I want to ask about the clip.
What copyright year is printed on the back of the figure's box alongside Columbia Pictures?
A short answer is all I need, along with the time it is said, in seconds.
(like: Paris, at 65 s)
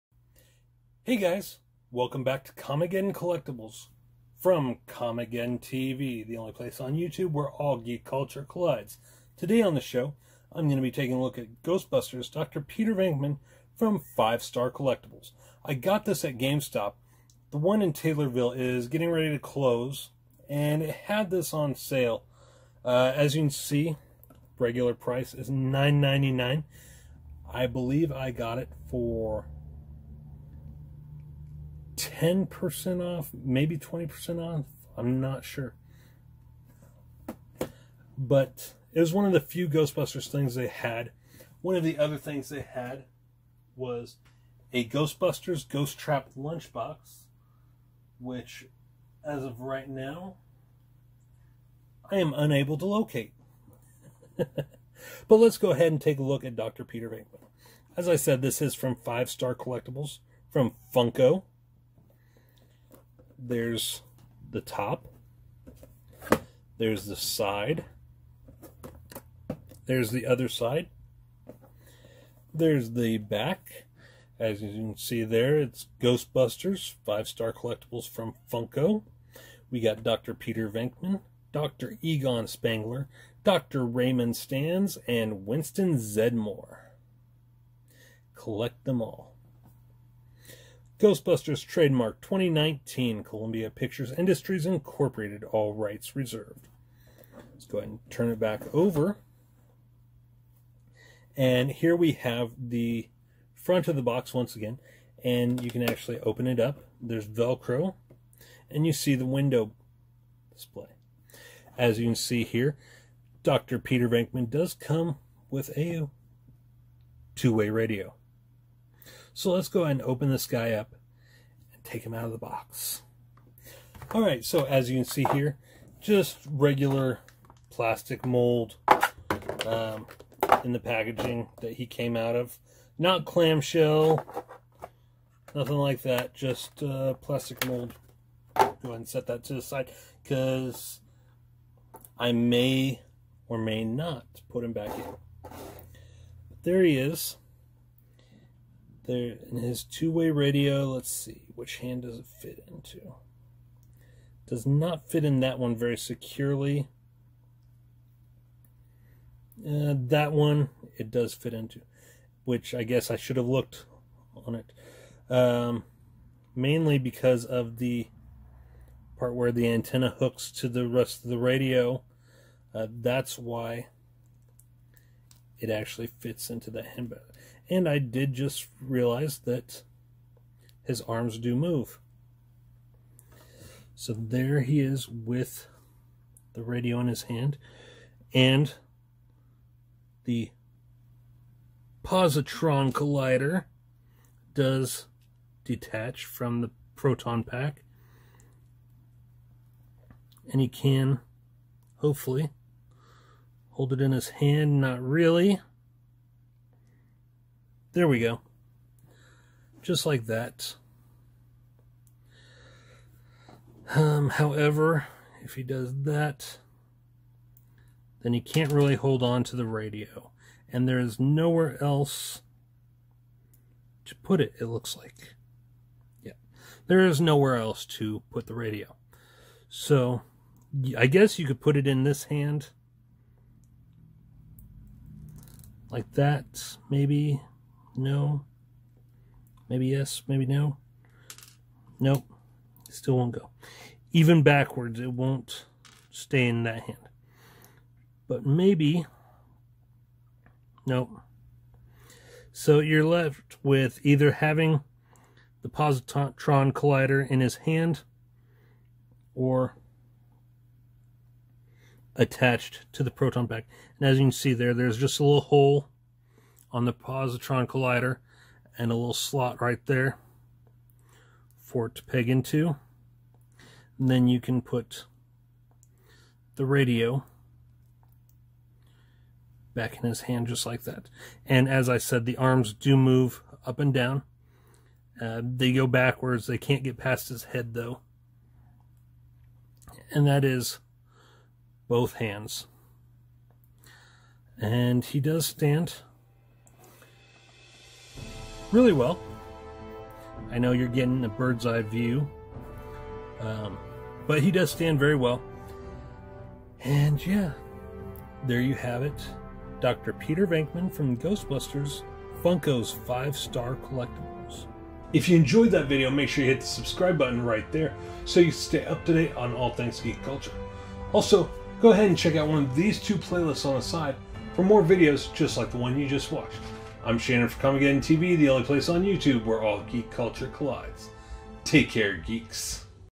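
2019, at 92 s.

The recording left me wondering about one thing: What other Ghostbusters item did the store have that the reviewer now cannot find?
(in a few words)
Ghost Trap lunchbox.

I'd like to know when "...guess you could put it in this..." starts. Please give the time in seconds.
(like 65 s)
231 s.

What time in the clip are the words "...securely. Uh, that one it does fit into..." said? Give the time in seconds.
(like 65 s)
155 s.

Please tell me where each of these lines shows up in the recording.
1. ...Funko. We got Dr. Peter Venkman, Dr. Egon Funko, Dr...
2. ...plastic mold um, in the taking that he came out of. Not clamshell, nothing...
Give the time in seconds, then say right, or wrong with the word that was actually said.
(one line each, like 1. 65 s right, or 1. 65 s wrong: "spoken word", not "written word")
1. 78 s wrong: "Spengler", not "Funko"
2. 127 s wrong: "packaging", not "taking".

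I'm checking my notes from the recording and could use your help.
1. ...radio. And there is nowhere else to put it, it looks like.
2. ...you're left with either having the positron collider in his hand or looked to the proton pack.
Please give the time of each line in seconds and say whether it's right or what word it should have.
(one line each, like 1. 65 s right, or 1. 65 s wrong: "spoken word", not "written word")
1. 219 s right
2. 252 s wrong: "attached", not "looked".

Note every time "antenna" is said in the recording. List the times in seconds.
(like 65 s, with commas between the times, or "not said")
169 s.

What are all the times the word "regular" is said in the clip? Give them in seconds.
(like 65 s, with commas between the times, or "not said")
24 s, 126 s.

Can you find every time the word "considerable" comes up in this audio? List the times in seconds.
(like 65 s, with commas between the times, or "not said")
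not said.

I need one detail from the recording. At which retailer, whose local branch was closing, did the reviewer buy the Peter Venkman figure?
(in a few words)
GameStop.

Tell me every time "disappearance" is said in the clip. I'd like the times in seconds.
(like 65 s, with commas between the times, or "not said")
not said.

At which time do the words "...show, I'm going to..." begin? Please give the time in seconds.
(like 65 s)
9 s.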